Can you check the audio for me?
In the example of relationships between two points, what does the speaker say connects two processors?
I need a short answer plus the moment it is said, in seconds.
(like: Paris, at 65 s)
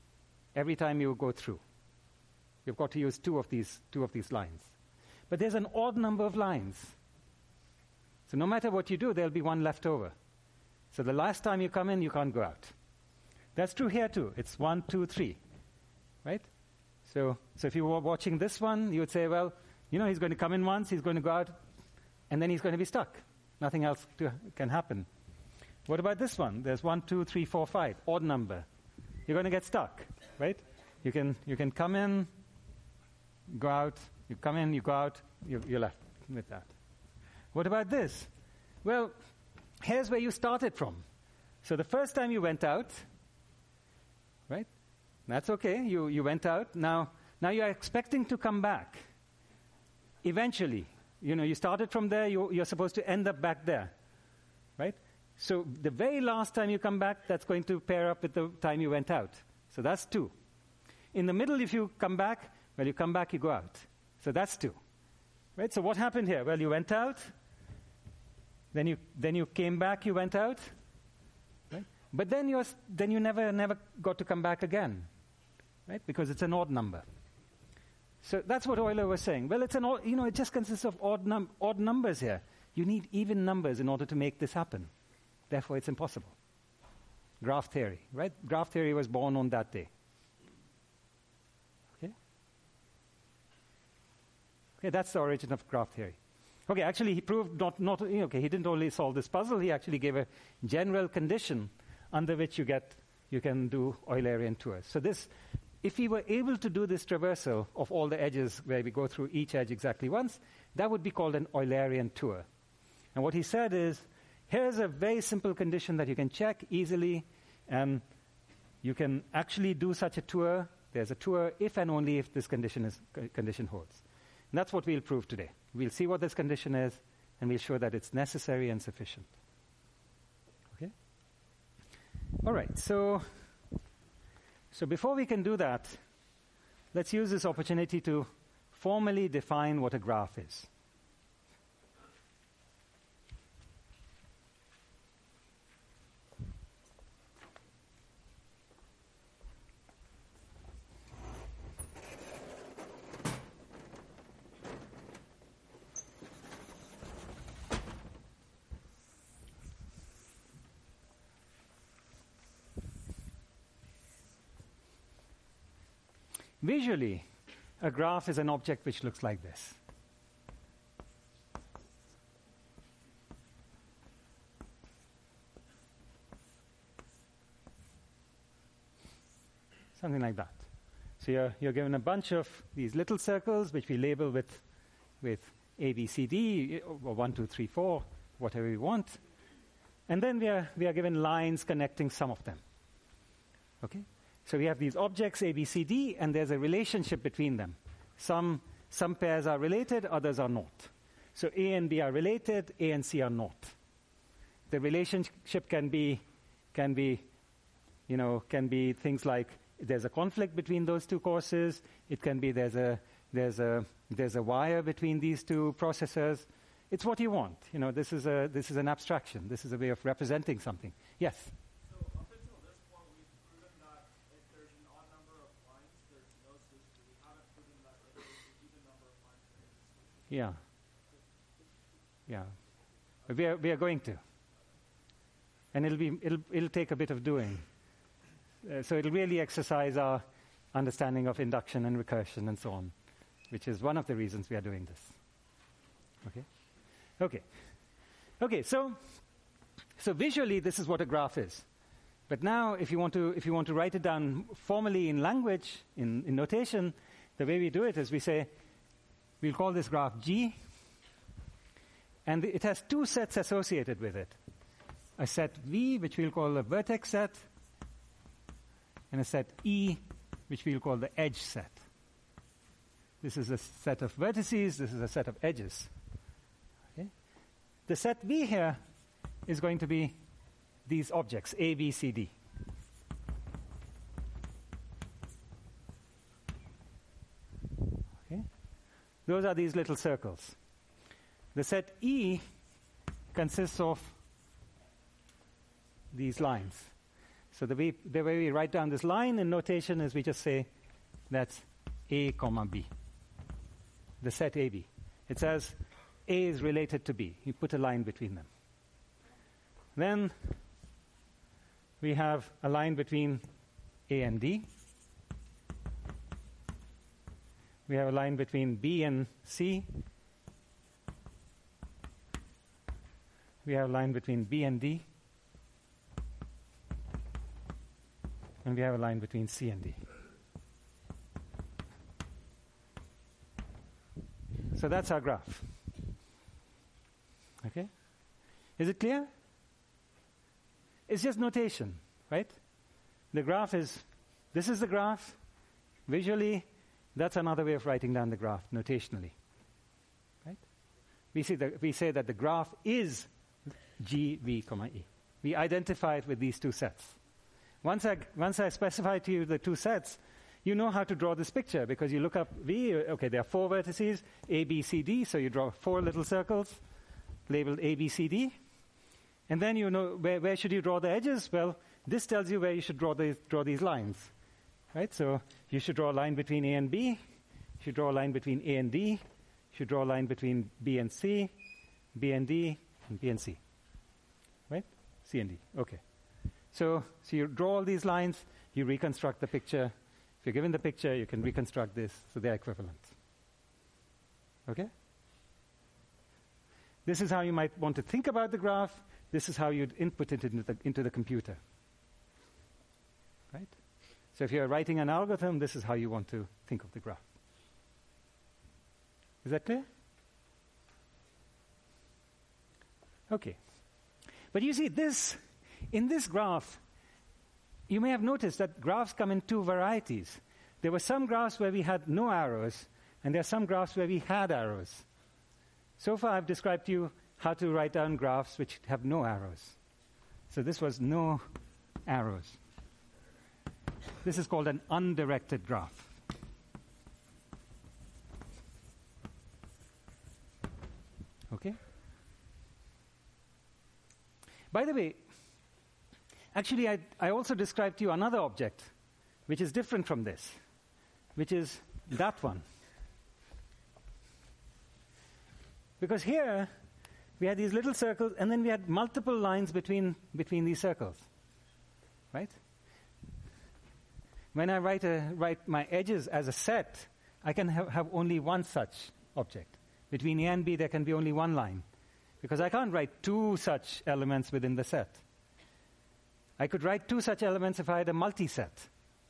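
a wire, at 214 s.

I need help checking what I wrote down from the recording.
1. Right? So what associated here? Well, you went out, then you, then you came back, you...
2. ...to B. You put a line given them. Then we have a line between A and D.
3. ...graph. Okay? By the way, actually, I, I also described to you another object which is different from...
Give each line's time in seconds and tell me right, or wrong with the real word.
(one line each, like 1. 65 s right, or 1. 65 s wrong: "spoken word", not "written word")
1. 65 s wrong: "happened", not "associated"
2. 307 s wrong: "between", not "given"
3. 435 s right.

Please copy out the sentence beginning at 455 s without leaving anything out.
Because here, we had these little circles, and then we had multiple lines between, between these circles.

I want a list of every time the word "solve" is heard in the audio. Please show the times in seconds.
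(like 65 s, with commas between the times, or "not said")
98 s.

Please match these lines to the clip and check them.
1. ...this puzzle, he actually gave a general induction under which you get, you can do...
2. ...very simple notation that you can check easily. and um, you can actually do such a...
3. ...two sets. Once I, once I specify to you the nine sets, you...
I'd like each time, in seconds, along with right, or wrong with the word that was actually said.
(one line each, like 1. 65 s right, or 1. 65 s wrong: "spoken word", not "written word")
1. 99 s wrong: "condition", not "induction"
2. 114 s wrong: "condition", not "notation"
3. 356 s wrong: "two", not "nine".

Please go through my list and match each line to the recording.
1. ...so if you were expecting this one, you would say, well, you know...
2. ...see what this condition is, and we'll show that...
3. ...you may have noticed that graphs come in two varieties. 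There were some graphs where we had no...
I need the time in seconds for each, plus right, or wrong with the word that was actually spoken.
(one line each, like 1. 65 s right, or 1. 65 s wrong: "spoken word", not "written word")
1. 17 s wrong: "watching", not "expecting"
2. 125 s right
3. 417 s right.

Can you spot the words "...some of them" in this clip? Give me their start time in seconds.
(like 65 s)
192 s.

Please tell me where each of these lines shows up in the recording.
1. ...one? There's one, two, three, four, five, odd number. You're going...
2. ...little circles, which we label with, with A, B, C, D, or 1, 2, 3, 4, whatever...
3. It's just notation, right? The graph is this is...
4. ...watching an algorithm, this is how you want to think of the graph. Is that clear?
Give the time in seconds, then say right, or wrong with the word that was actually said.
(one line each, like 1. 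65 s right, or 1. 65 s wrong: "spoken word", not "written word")
1. 26 s right
2. 182 s right
3. 341 s right
4. 404 s wrong: "writing", not "watching".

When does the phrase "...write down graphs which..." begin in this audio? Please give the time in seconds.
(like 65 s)
427 s.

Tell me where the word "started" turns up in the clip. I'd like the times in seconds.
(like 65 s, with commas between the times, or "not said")
40 s, 51 s.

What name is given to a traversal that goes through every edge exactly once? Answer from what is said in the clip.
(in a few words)
Eulerian tour.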